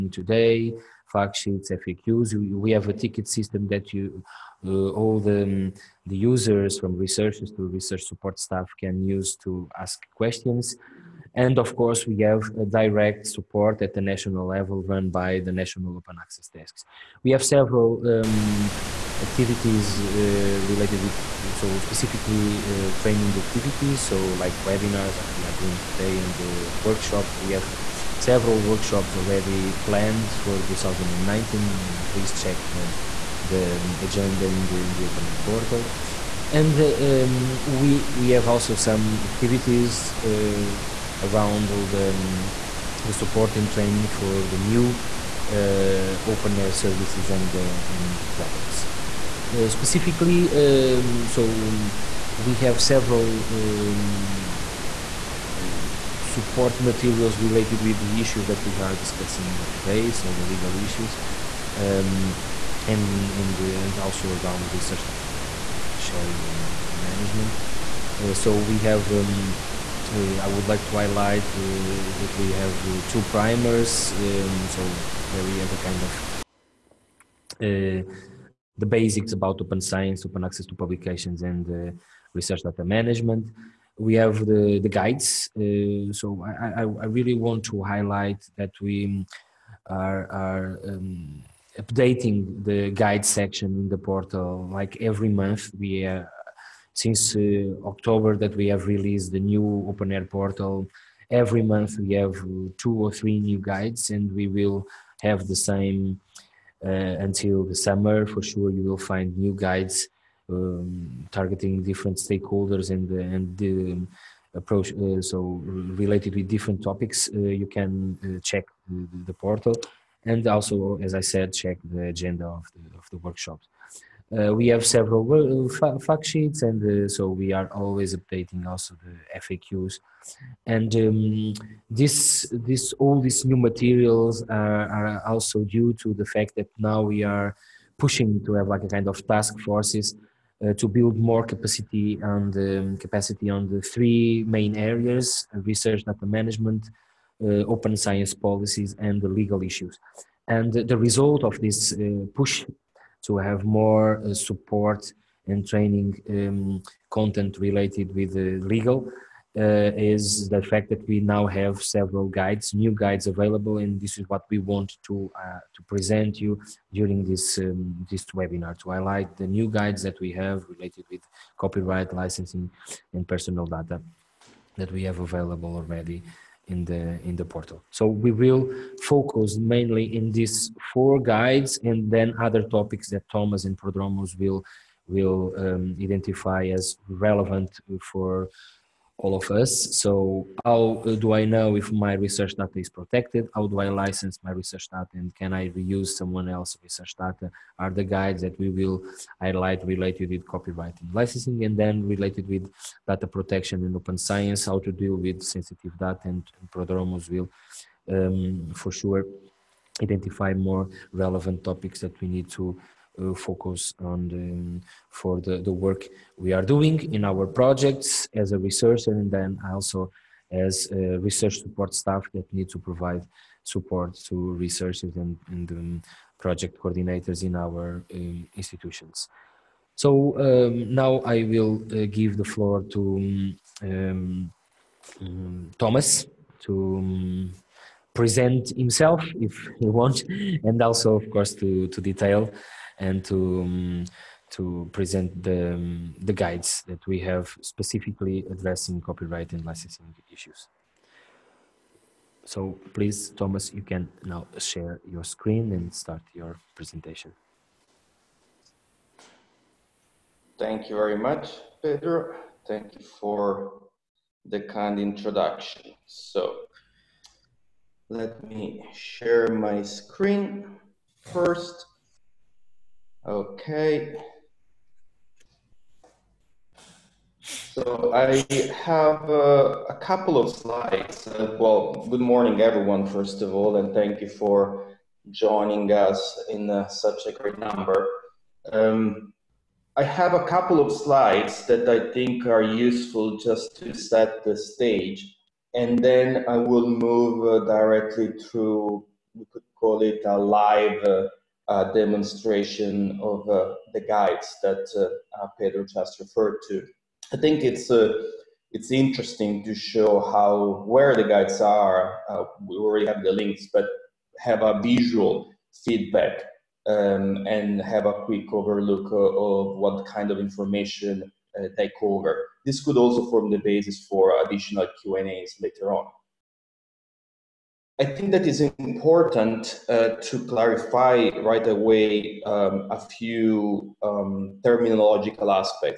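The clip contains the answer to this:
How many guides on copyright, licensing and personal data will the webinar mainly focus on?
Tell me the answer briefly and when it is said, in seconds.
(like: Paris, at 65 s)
4, at 180 s.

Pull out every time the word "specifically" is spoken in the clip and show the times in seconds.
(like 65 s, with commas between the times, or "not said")
21 s, 49 s, 247 s.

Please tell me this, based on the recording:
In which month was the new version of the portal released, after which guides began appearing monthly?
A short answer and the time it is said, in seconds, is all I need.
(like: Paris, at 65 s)
October, at 97 s.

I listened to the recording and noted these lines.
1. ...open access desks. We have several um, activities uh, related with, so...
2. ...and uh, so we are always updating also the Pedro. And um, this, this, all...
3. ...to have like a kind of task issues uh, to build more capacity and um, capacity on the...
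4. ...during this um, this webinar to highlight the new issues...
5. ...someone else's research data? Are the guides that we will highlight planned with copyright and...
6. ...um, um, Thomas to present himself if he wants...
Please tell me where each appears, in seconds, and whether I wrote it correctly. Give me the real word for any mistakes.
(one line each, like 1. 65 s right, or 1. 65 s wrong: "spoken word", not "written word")
1. 15 s right
2. 126 s wrong: "FAQs", not "Pedro"
3. 138 s wrong: "forces", not "issues"
4. 166 s wrong: "guides", not "issues"
5. 196 s wrong: "related", not "planned"
6. 233 s right.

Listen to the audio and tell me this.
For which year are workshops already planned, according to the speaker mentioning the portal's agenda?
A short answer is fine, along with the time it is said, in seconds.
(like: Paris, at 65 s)
2019, at 30 s.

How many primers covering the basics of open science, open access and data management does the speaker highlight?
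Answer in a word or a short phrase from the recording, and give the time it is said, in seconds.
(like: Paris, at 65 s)
2, at 73 s.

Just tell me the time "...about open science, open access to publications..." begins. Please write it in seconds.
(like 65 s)
79 s.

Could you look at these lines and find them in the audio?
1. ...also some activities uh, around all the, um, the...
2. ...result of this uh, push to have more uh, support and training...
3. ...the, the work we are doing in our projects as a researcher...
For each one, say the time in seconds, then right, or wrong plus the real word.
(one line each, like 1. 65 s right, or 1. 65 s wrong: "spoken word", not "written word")
1. 38 s right
2. 150 s right
3. 215 s right.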